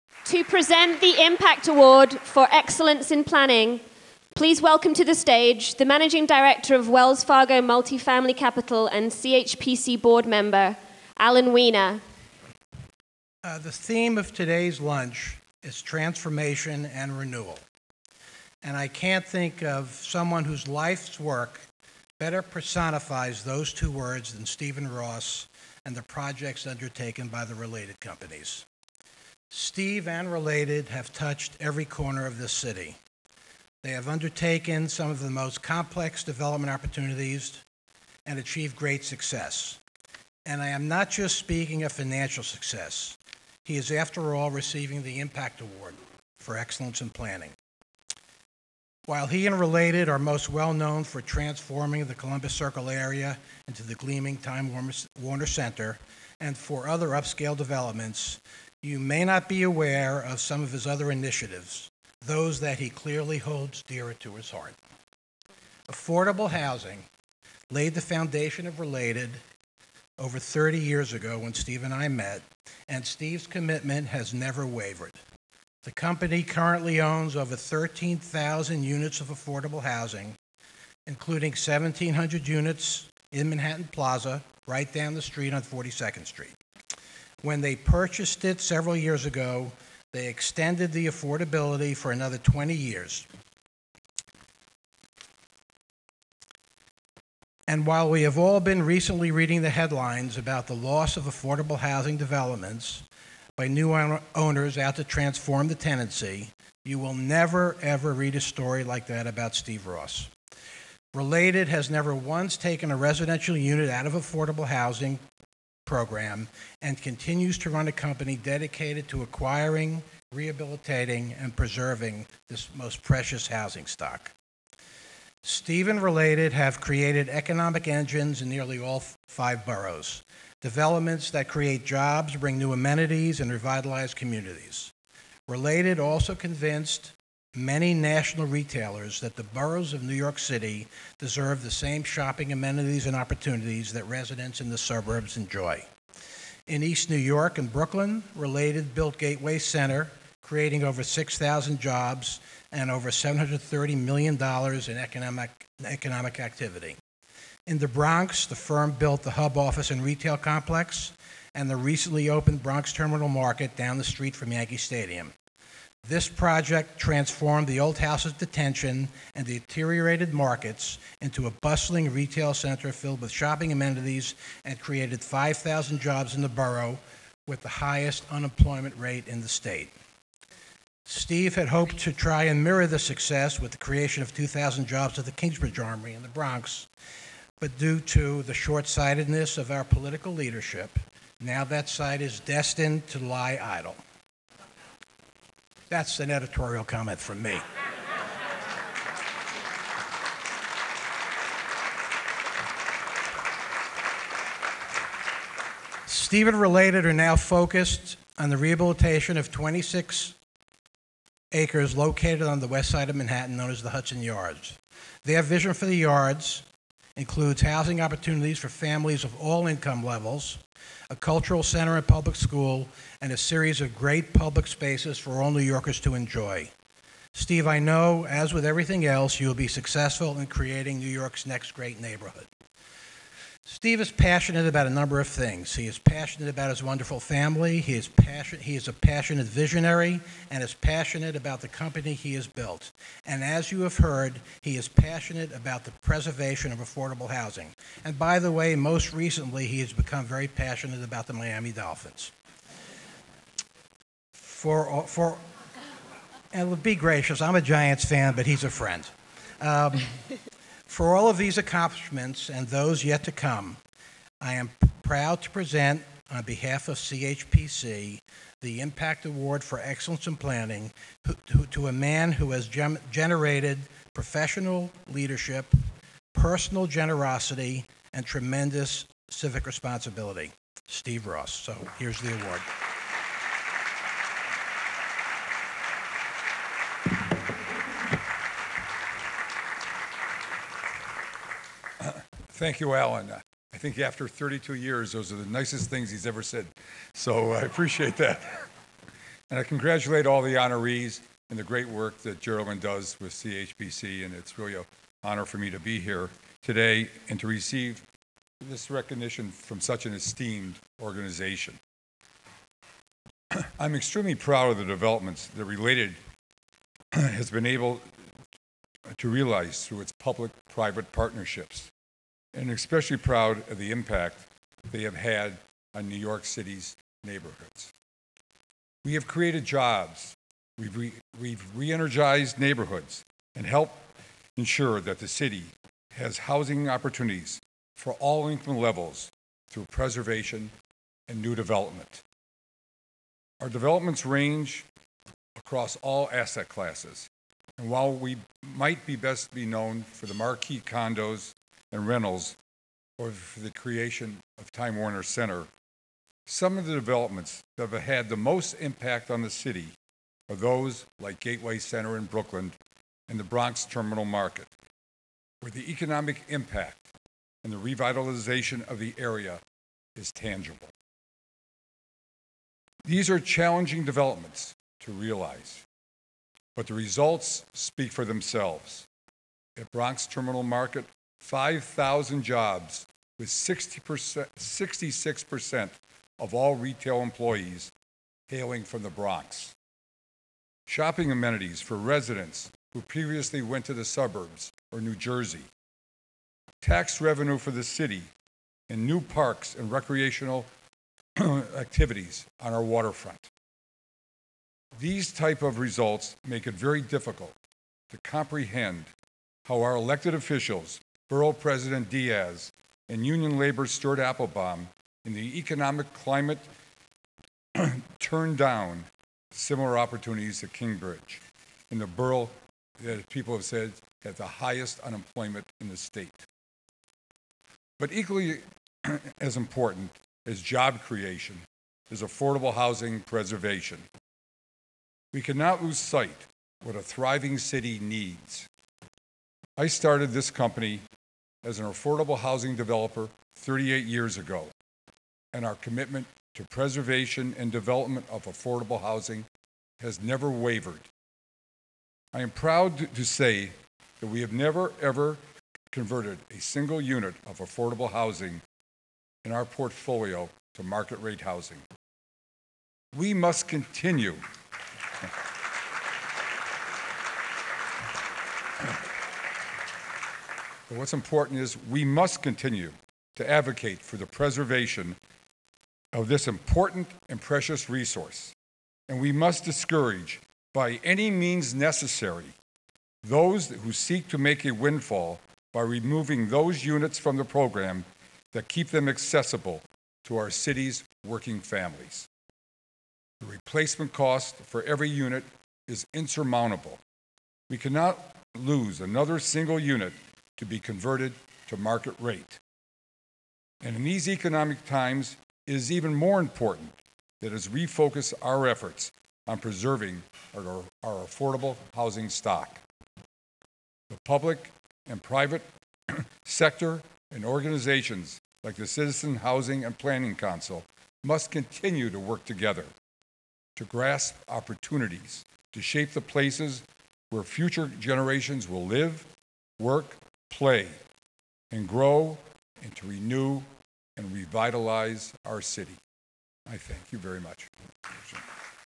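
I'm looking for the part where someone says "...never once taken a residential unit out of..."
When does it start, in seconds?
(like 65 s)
111 s.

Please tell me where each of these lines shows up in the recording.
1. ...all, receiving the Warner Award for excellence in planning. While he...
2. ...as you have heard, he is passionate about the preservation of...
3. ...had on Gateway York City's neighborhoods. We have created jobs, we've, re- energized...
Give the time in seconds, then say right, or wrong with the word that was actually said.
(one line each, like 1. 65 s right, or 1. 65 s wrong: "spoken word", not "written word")
1. 44 s wrong: "Impact", not "Warner"
2. 243 s right
3. 325 s wrong: "New", not "Gateway".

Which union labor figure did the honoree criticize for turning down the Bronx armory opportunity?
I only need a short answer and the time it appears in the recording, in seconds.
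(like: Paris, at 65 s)
Stuart Applebaum, at 413 s.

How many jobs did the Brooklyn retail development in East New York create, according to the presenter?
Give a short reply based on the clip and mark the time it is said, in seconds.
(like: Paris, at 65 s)
6,000, at 151 s.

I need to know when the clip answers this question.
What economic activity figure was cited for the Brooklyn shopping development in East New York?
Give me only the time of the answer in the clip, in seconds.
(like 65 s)
153 s.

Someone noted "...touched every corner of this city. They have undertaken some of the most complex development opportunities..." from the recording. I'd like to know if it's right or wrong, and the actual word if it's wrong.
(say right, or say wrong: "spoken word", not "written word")
right.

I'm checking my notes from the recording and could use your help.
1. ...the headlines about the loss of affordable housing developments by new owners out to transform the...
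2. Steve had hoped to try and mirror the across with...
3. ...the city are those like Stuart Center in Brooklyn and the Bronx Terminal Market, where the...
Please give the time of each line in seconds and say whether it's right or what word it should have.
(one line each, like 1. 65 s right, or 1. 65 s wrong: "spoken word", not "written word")
1. 99 s right
2. 181 s wrong: "success", not "across"
3. 359 s wrong: "Gateway", not "Stuart".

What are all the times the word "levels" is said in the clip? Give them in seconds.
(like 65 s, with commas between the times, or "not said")
220 s, 338 s.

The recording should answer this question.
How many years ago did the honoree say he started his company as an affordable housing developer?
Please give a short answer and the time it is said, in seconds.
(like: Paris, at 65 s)
38, at 443 s.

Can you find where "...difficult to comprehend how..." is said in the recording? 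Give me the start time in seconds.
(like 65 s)
407 s.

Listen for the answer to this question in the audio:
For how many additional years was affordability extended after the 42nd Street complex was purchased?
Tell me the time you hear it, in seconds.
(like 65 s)
92 s.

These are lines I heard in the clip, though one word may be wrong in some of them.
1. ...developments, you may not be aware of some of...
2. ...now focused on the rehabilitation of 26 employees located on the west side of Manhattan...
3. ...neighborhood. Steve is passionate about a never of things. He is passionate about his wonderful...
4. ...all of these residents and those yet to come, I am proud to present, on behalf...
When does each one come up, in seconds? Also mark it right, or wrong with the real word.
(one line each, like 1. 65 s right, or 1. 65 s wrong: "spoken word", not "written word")
1. 57 s right
2. 207 s wrong: "acres", not "employees"
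3. 232 s wrong: "number", not "never"
4. 261 s wrong: "accomplishments", not "residents".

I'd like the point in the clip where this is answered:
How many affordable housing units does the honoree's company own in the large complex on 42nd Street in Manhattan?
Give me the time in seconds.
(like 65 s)
81 s.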